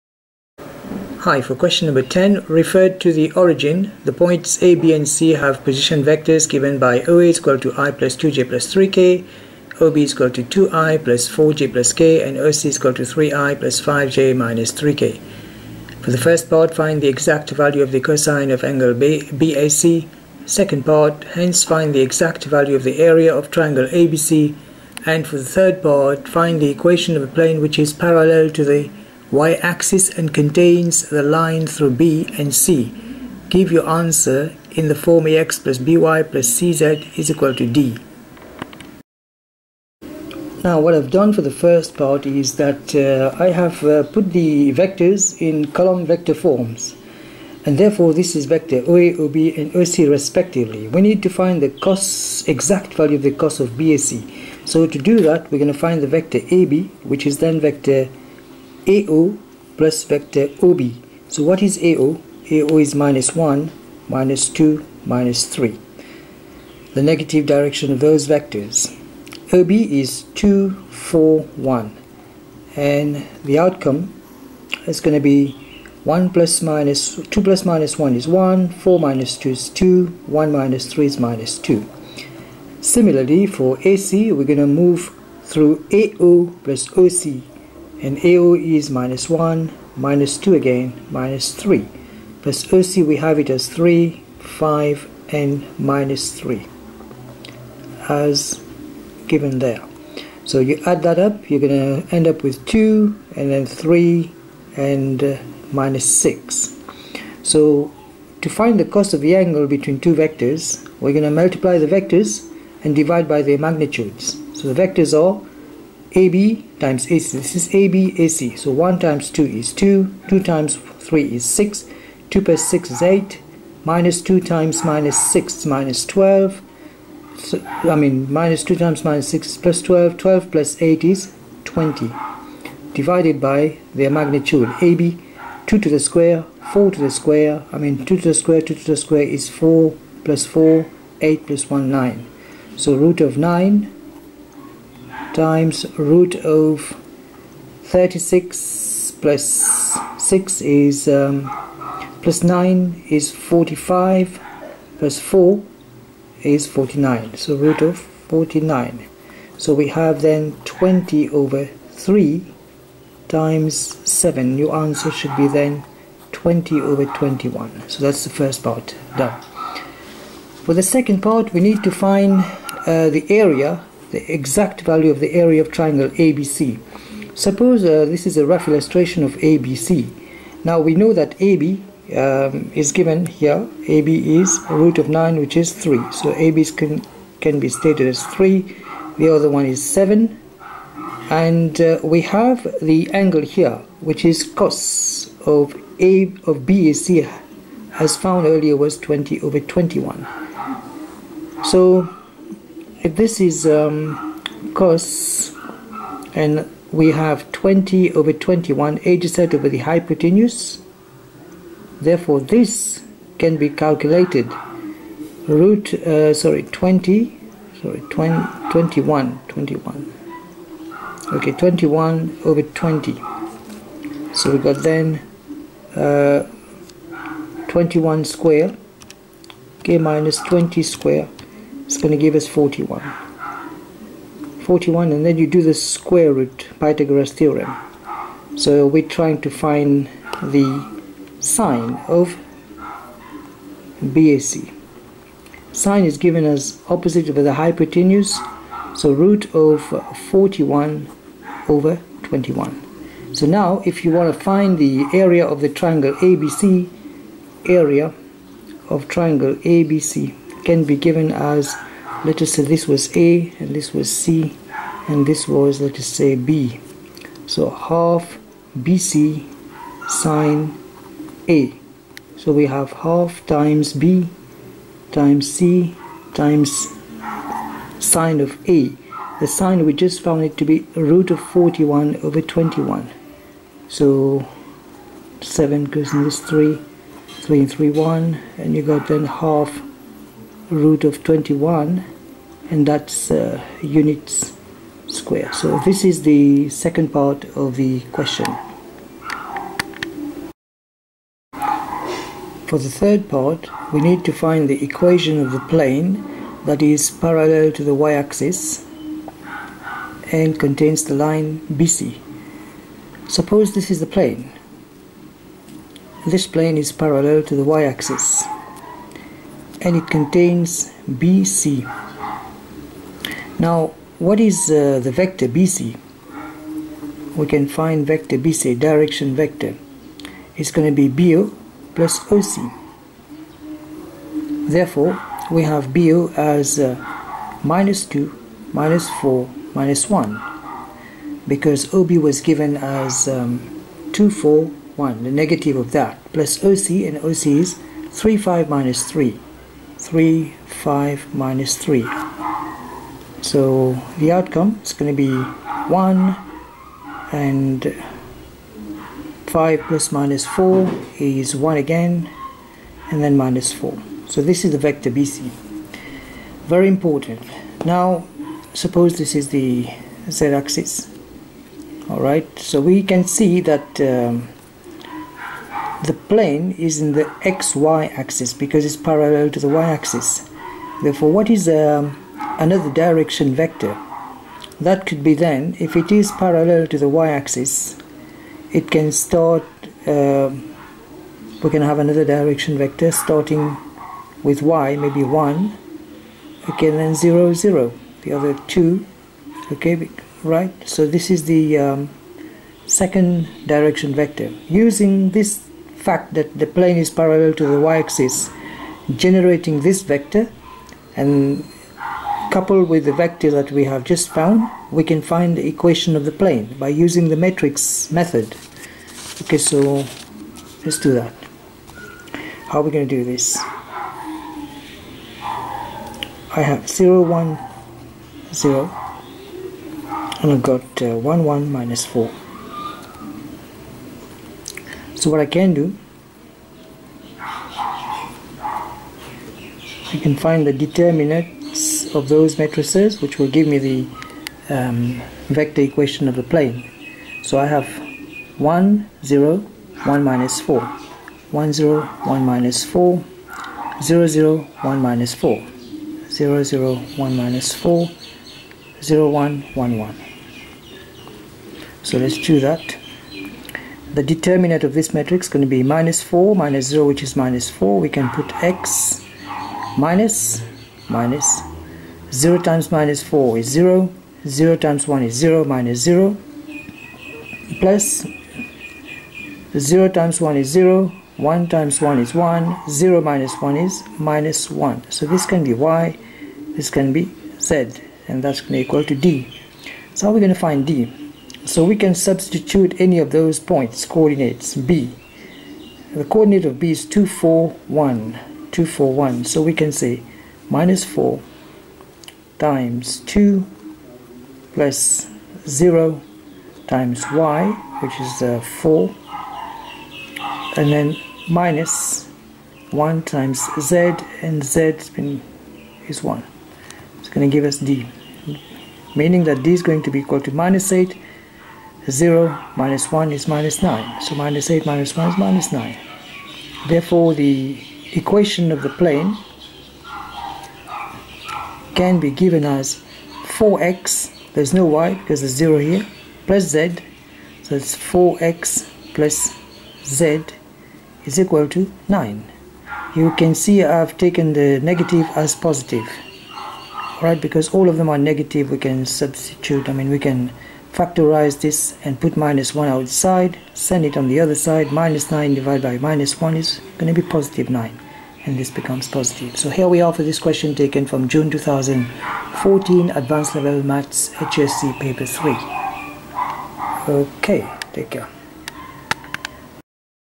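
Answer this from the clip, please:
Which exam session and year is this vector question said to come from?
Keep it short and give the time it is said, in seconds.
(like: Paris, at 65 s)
June 2014, at 561 s.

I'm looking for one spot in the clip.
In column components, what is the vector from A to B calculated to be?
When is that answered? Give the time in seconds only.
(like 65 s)
78 s.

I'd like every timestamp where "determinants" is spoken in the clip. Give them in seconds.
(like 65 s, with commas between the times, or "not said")
440 s, 464 s.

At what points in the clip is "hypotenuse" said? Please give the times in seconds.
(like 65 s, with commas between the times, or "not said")
209 s, 247 s.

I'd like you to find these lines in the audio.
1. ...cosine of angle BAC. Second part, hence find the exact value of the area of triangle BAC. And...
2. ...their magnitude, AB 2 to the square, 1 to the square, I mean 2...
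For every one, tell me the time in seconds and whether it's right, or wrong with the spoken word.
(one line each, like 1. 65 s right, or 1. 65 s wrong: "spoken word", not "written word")
1. 18 s wrong: "ABC", not "BAC"
2. 133 s wrong: "4", not "1".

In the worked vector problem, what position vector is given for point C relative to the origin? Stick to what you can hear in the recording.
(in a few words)
3i + 5j - 3k.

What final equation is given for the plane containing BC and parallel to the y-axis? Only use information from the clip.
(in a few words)
4x + z = 9.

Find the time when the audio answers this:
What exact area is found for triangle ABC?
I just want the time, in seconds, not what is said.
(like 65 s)
289 s.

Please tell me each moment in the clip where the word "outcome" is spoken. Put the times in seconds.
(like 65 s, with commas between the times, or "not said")
73 s, 354 s.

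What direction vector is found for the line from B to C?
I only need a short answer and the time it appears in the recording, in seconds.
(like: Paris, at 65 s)
1, 1, -4, at 355 s.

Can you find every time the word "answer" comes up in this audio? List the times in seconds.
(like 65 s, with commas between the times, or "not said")
33 s, 164 s.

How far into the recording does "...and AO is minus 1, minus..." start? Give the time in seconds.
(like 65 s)
88 s.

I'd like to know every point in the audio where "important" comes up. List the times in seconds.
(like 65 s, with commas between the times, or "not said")
366 s.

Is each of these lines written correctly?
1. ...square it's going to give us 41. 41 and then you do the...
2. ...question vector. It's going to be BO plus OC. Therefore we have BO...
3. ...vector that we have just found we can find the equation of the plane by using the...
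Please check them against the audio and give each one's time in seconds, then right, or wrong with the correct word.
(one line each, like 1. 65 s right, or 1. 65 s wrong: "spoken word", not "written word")
1. 230 s right
2. 328 s wrong: "direction", not "question"
3. 413 s right.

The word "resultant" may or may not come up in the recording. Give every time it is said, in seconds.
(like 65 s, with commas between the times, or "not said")
not said.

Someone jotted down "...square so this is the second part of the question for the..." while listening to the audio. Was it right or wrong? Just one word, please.
right.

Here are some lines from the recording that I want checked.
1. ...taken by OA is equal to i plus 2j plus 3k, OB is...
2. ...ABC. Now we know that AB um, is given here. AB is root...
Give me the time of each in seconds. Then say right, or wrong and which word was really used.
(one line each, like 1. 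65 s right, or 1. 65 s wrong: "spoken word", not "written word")
1. 6 s wrong: "given", not "taken"
2. 179 s right.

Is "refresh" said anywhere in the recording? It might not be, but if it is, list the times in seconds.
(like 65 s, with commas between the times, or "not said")
not said.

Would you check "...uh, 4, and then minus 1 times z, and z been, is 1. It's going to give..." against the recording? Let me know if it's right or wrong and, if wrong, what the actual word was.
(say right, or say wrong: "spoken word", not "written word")
right.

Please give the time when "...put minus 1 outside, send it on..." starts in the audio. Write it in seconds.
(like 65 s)
552 s.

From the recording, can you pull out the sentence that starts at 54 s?
So to do that we're going to find the vector AB which is then vector AO plus vector OB.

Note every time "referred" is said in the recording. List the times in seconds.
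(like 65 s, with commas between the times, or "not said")
2 s.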